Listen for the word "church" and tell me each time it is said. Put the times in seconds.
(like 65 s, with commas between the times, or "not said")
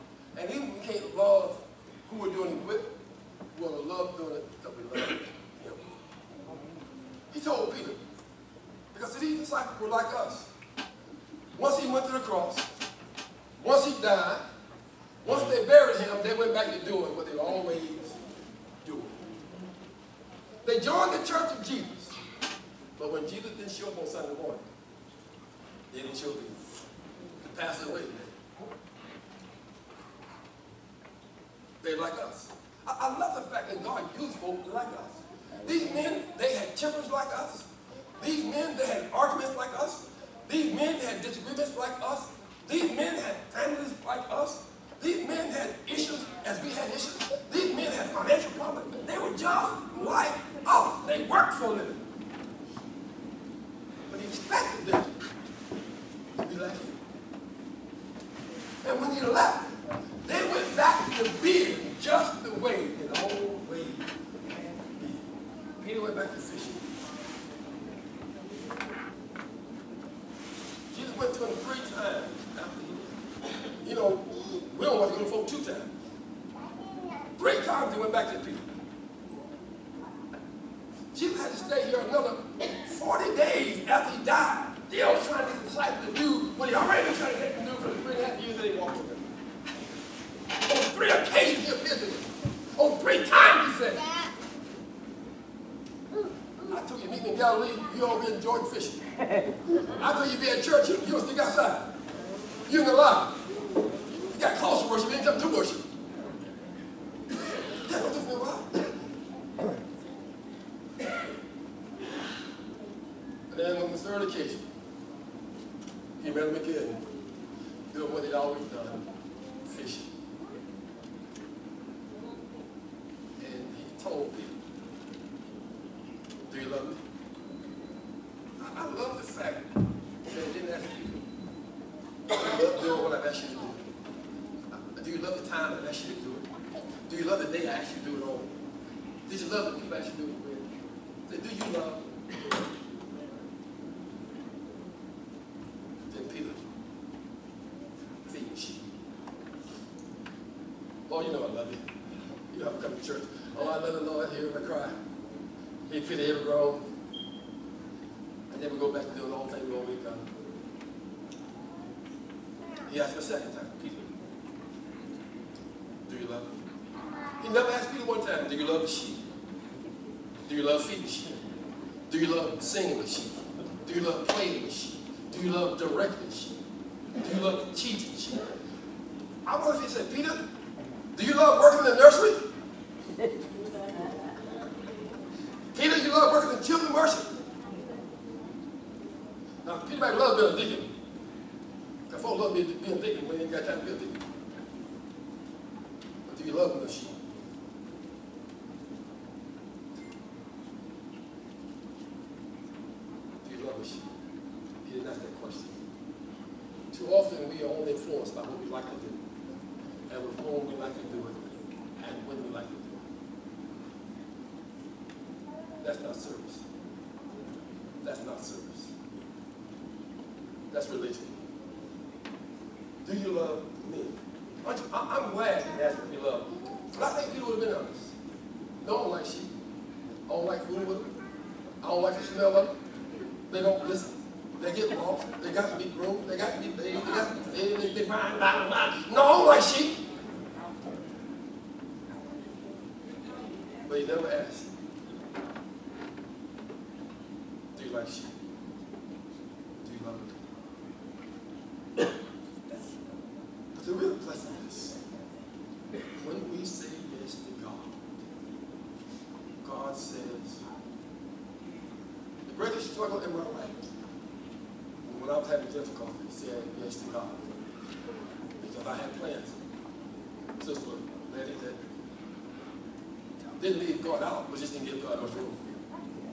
21 s, 100 s.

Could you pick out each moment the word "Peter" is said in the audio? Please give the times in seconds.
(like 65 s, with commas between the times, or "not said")
7 s, 78 s, 163 s, 167 s, 180 s, 227 s.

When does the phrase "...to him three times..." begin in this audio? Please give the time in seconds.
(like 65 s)
71 s.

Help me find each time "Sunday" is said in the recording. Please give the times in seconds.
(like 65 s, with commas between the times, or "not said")
24 s.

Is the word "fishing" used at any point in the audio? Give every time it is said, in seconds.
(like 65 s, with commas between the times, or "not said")
66 s.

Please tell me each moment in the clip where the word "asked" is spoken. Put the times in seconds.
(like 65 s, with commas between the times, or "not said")
162 s, 167 s, 244 s.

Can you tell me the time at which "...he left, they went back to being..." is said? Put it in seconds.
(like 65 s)
59 s.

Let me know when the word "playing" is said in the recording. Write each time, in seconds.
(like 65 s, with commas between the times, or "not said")
174 s.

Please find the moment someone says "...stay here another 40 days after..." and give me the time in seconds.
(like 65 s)
81 s.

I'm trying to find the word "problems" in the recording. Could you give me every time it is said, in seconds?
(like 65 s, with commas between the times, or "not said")
48 s.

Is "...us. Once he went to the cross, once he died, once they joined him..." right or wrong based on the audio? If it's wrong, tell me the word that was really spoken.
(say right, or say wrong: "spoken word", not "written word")
wrong: "buried", not "joined".